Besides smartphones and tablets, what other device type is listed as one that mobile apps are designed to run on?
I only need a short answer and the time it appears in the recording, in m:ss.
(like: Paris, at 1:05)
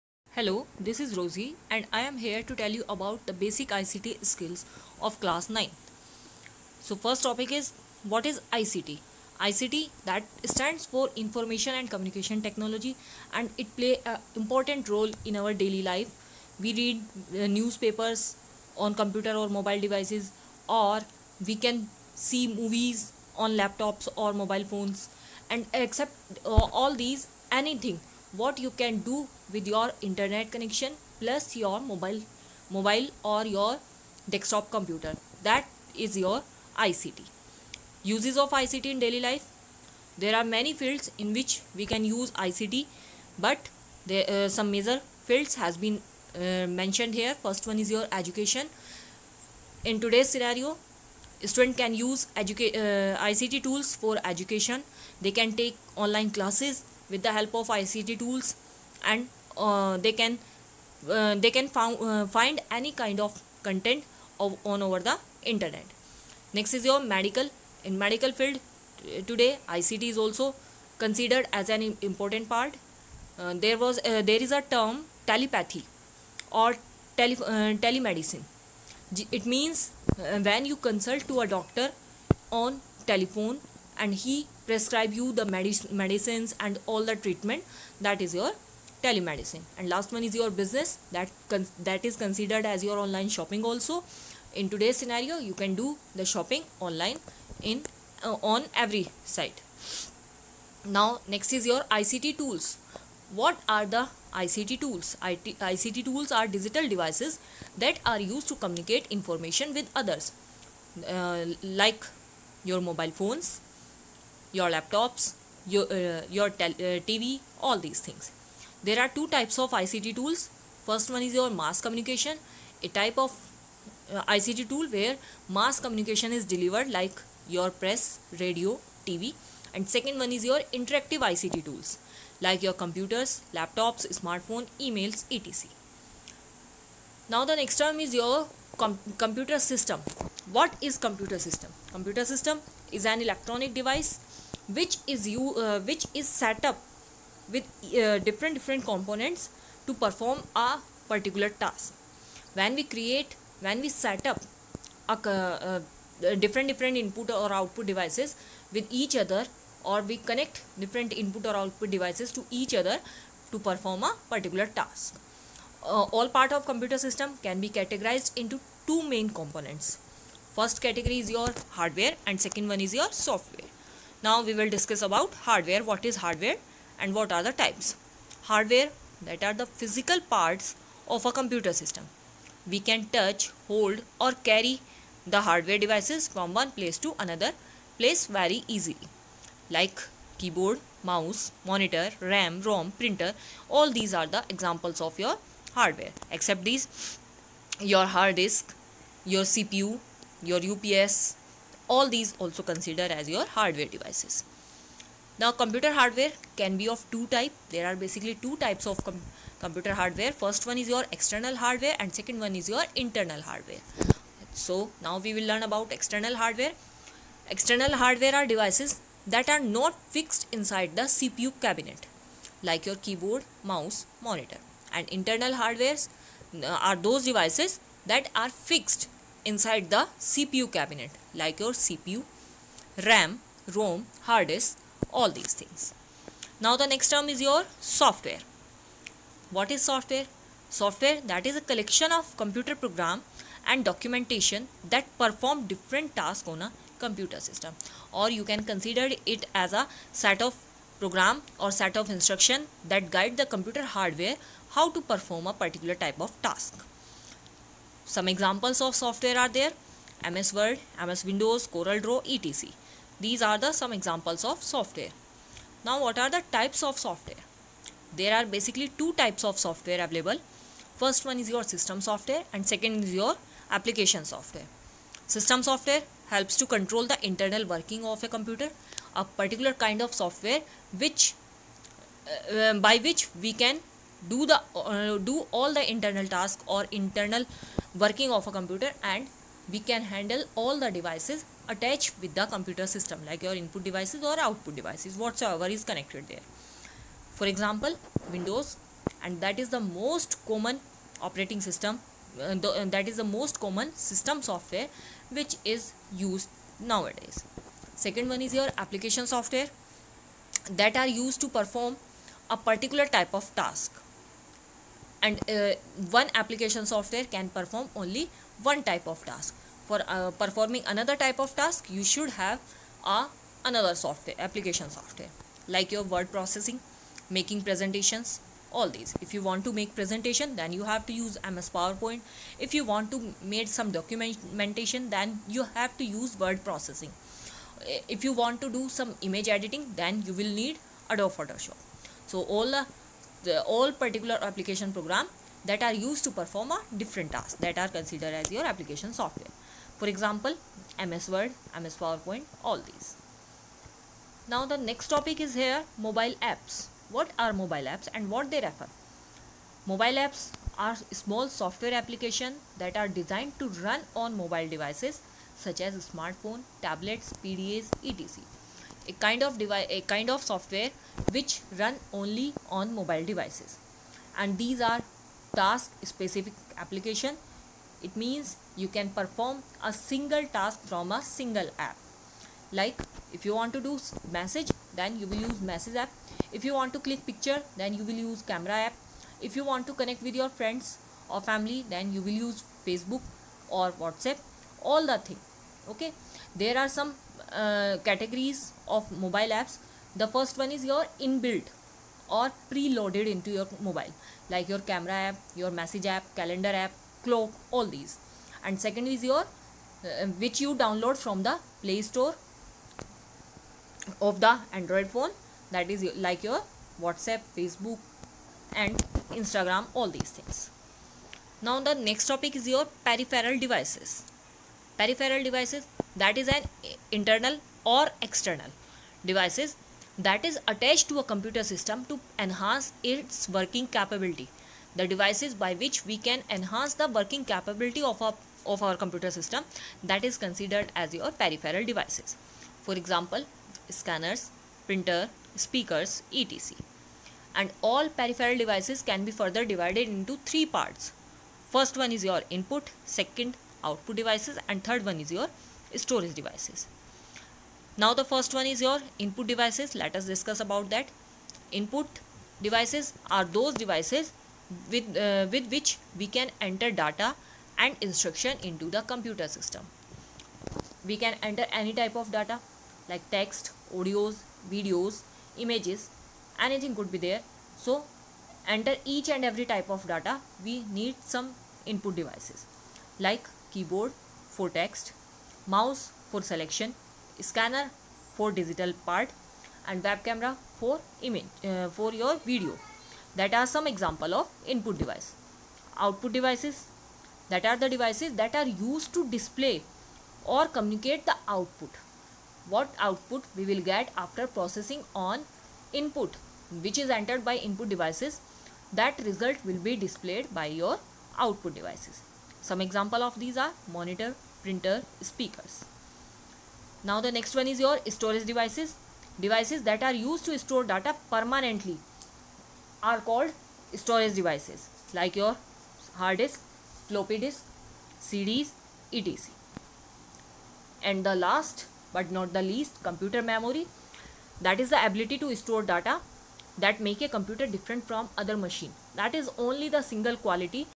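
PDAs, at 6:07.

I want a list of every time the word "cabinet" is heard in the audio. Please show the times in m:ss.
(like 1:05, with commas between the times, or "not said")
3:41, 3:50.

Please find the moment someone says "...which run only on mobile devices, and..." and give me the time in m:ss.
6:11.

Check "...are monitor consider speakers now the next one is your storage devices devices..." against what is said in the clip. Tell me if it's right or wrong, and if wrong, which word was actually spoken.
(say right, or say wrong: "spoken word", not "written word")
wrong: "printer", not "consider".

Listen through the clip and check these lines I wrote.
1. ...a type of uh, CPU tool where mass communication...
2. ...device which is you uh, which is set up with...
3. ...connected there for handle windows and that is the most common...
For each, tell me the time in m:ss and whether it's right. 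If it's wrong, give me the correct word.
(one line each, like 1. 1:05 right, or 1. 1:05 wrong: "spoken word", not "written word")
1. 2:02 wrong: "ICT", not "CPU"
2. 2:23 right
3. 4:55 wrong: "example", not "handle".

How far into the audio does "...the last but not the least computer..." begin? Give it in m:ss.
8:51.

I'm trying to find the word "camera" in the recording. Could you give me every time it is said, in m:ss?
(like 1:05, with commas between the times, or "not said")
6:28, 6:44, 8:10.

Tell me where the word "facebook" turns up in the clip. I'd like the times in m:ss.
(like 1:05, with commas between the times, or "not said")
6:32, 6:57.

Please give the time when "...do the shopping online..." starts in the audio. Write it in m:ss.
1:35.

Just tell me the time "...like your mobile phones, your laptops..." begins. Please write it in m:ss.
1:51.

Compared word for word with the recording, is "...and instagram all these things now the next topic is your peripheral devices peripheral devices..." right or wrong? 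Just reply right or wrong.
right.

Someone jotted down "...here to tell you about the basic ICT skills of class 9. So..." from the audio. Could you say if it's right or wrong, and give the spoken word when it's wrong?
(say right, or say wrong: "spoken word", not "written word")
right.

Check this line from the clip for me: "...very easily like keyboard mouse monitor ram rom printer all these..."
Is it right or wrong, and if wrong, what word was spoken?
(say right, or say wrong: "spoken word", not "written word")
right.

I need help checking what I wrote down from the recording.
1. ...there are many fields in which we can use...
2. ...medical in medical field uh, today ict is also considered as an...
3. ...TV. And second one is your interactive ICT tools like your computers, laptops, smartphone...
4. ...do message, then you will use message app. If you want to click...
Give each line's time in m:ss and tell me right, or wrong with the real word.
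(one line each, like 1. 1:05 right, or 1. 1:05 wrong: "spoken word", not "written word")
1. 0:40 right
2. 1:06 right
3. 2:09 right
4. 6:23 right.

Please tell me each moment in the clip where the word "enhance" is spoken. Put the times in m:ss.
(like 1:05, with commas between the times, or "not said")
7:12, 7:16.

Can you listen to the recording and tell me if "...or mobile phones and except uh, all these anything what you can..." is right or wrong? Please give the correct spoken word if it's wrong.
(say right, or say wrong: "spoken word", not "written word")
right.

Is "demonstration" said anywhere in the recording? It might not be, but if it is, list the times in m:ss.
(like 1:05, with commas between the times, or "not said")
not said.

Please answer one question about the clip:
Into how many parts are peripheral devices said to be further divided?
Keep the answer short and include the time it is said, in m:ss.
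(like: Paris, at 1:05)
3, at 7:30.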